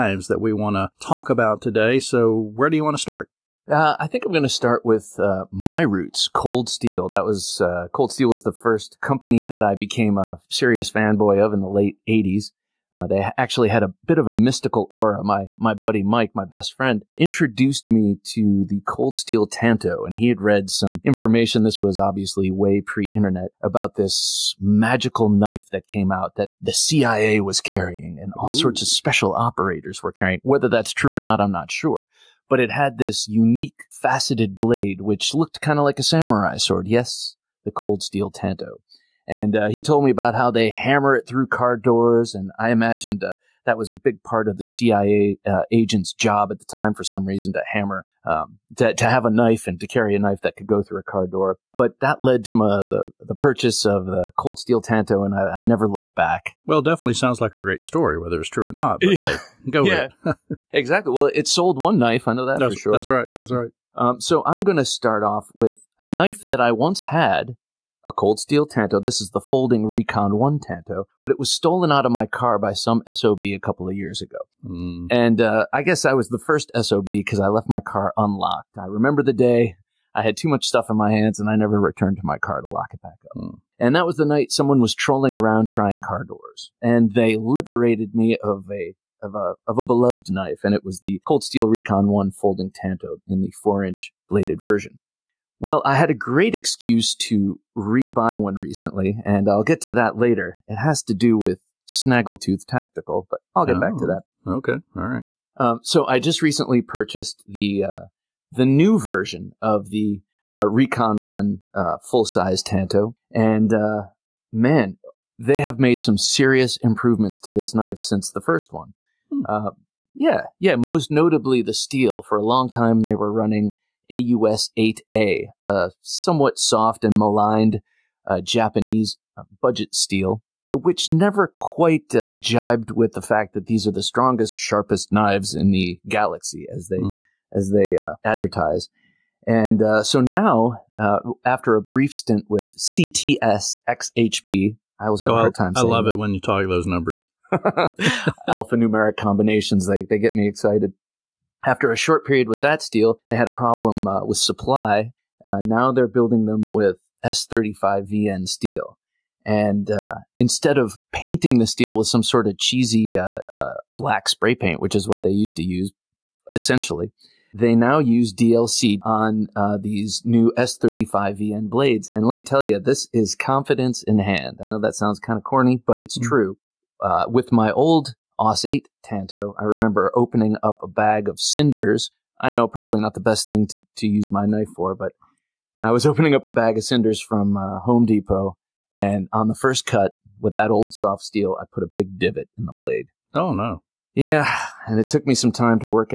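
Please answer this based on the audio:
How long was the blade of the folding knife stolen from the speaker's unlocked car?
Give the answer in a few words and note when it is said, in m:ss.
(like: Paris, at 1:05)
4 inch, at 1:33.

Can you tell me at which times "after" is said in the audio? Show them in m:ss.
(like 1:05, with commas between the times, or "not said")
2:21, 2:31.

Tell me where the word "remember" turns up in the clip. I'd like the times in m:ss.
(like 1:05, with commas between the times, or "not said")
1:18, 2:59.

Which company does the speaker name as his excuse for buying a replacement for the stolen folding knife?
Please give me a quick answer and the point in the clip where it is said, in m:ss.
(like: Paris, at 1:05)
Snaggletooth Tactical, at 1:41.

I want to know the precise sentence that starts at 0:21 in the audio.
This was obviously way pre-internet about this magical knife that came out that the CIA was carrying, and all Ooh.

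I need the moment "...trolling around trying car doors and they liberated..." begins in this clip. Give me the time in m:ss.
1:24.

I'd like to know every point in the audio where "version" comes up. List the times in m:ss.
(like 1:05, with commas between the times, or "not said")
1:34, 1:48.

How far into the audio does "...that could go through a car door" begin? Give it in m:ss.
0:50.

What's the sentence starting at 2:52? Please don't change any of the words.
And let me tell you, this is confidence in hand.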